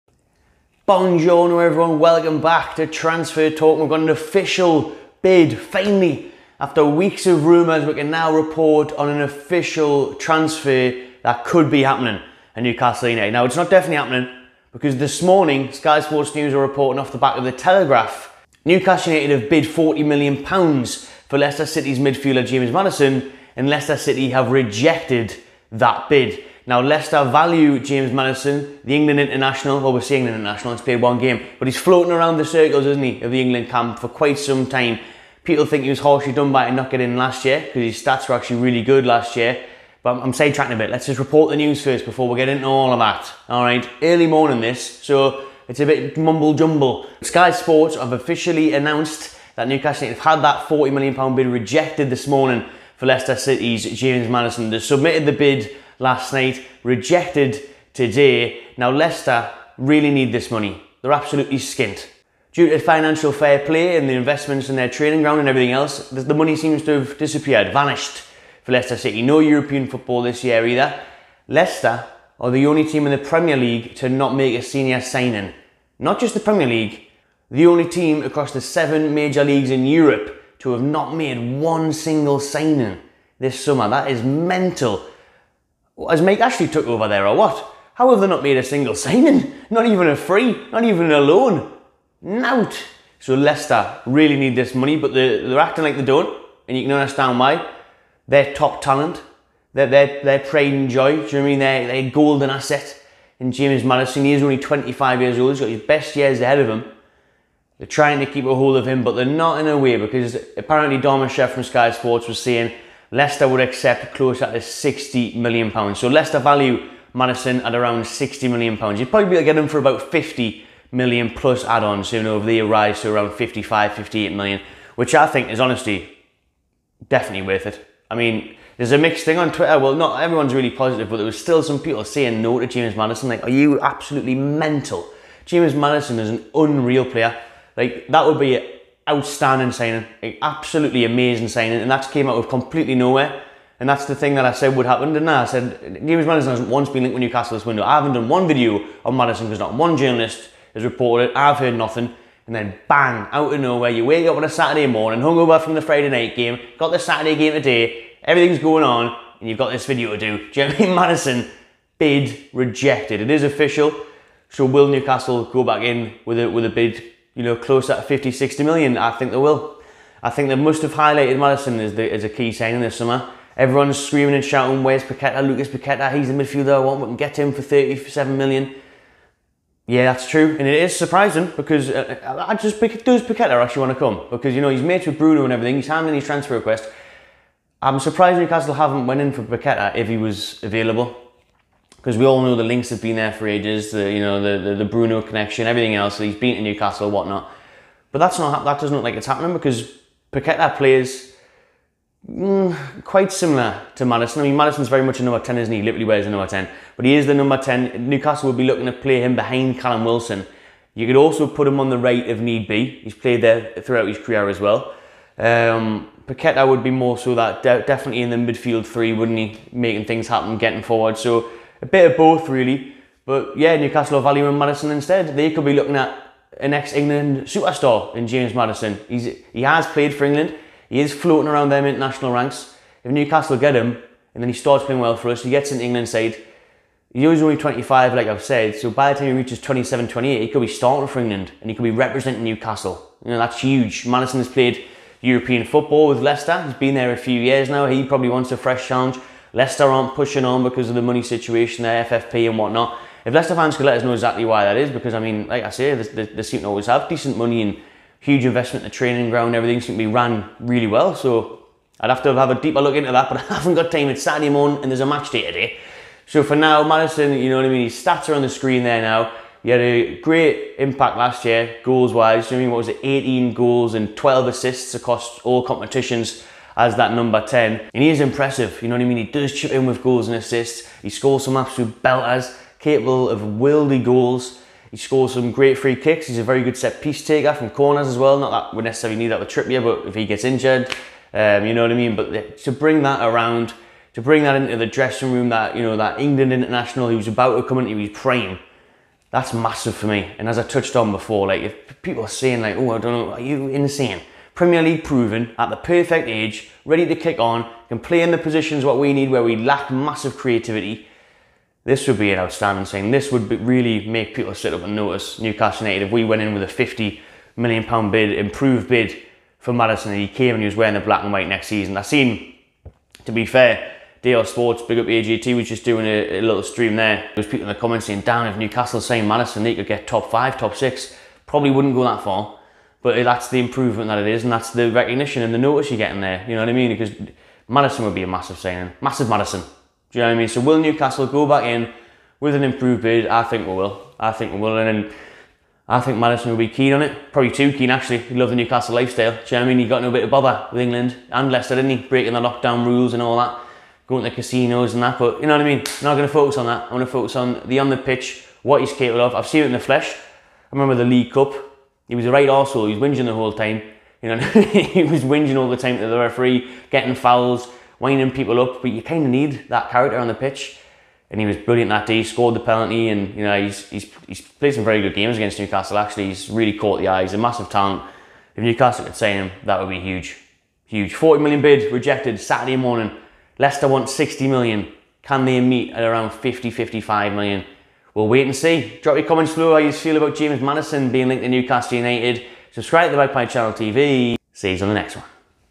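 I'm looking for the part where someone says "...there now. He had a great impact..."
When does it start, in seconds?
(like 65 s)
268 s.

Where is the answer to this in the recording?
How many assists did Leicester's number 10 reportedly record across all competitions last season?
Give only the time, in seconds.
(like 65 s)
274 s.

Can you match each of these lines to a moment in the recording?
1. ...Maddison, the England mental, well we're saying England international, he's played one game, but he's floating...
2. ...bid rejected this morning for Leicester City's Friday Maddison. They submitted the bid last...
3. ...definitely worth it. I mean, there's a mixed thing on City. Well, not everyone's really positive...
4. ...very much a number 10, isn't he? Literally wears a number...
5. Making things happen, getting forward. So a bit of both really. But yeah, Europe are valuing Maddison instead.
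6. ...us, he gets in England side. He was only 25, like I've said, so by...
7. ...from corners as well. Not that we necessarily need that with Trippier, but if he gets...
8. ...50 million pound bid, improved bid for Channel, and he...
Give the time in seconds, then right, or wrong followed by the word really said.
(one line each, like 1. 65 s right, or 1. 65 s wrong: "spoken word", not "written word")
1. 28 s wrong: "international", not "mental"
2. 51 s wrong: "James", not "Friday"
3. 127 s wrong: "Twitter", not "City"
4. 204 s right
5. 219 s wrong: "Newcastle", not "Europe"
6. 235 s right
7. 287 s right
8. 316 s wrong: "Maddison", not "Channel".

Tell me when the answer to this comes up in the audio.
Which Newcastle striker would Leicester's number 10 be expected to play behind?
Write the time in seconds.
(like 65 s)
209 s.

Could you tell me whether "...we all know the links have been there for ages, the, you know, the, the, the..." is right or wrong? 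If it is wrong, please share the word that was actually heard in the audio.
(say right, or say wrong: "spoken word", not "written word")
right.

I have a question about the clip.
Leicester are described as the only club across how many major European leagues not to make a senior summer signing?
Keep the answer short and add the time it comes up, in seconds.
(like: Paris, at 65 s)
7, at 78 s.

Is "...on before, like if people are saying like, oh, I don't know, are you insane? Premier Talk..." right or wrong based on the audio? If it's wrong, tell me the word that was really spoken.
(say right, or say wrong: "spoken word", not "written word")
wrong: "League", not "Talk".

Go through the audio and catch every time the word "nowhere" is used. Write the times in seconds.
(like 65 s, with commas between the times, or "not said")
142 s, 153 s.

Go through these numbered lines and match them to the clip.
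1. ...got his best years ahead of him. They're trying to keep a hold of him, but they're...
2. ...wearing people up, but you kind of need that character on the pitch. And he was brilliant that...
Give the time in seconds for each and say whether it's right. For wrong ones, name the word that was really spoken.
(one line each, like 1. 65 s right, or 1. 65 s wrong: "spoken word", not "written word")
1. 105 s right
2. 368 s wrong: "winding", not "wearing".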